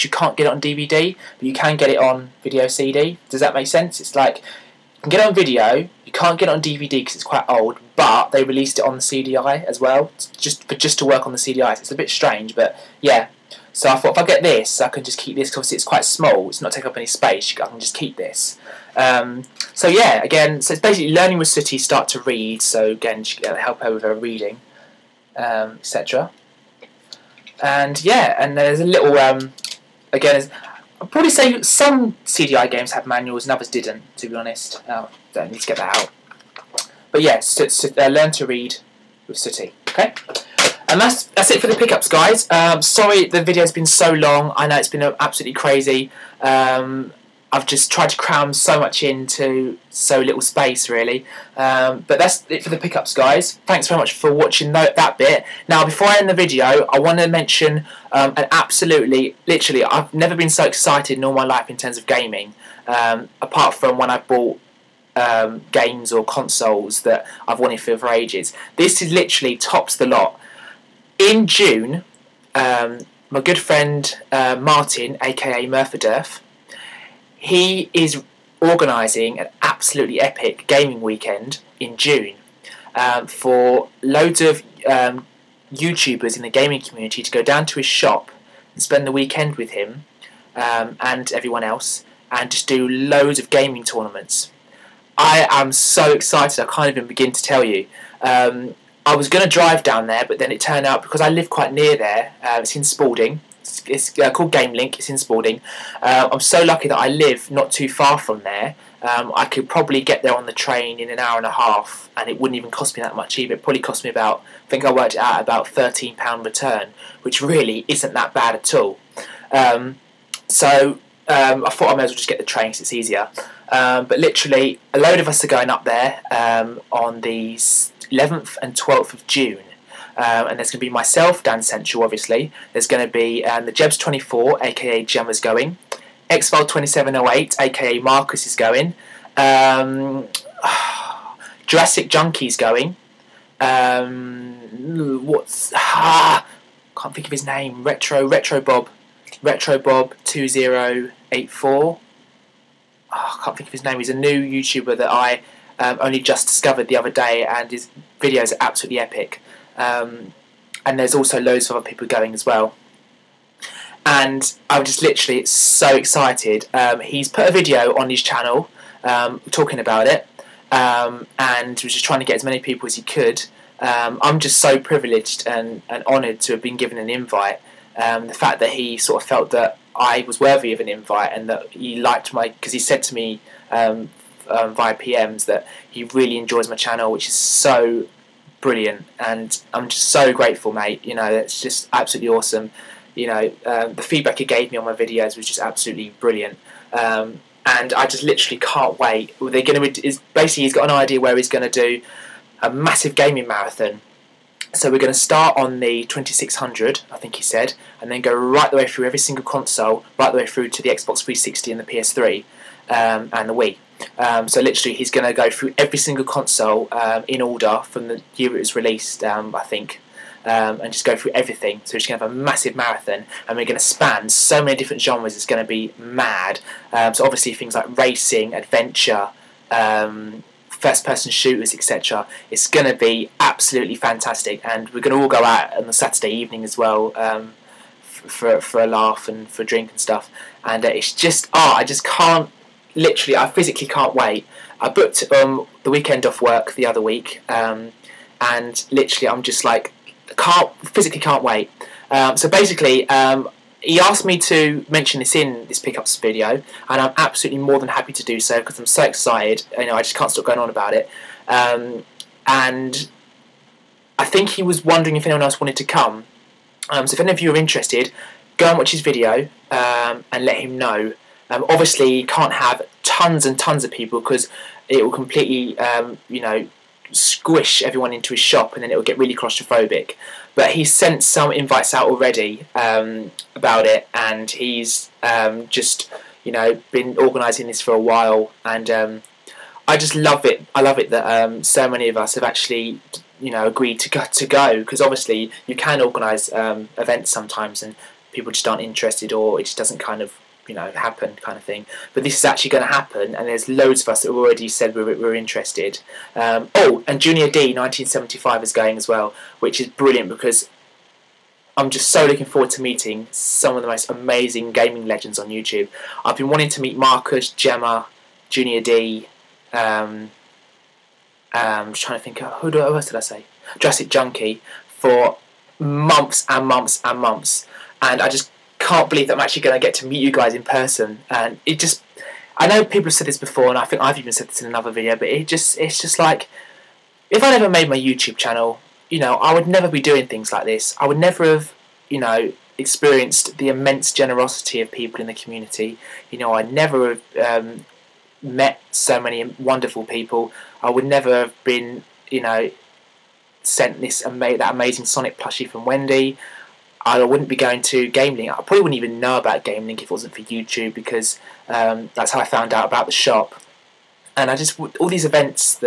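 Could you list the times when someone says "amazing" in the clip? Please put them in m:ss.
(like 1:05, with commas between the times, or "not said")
5:14, 5:54.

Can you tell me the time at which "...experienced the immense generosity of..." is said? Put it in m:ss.
5:42.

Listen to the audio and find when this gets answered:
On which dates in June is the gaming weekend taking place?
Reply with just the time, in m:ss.
2:07.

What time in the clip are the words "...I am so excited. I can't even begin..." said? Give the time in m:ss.
1:35.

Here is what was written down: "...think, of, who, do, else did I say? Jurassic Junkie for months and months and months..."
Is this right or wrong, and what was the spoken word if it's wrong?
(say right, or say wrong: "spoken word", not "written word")
right.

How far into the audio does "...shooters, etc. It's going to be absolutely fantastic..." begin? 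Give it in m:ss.
3:51.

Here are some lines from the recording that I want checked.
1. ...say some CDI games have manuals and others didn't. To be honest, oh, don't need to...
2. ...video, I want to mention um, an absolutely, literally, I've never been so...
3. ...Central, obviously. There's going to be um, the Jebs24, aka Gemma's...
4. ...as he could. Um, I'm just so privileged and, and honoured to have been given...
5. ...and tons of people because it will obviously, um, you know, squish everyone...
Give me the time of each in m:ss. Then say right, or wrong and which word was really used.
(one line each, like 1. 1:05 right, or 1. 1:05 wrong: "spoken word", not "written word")
1. 0:31 right
2. 0:56 right
3. 2:11 right
4. 2:52 right
5. 4:33 wrong: "completely", not "obviously".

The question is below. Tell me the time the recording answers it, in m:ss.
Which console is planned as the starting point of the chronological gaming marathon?
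3:26.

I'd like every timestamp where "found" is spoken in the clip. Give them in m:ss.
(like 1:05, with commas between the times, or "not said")
6:02.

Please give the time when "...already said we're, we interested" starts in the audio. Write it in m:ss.
5:04.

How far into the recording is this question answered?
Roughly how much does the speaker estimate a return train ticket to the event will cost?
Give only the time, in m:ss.
1:55.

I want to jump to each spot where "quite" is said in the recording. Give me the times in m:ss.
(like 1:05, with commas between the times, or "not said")
0:07, 0:15, 1:41.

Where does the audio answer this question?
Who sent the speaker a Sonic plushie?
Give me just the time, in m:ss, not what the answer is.
5:55.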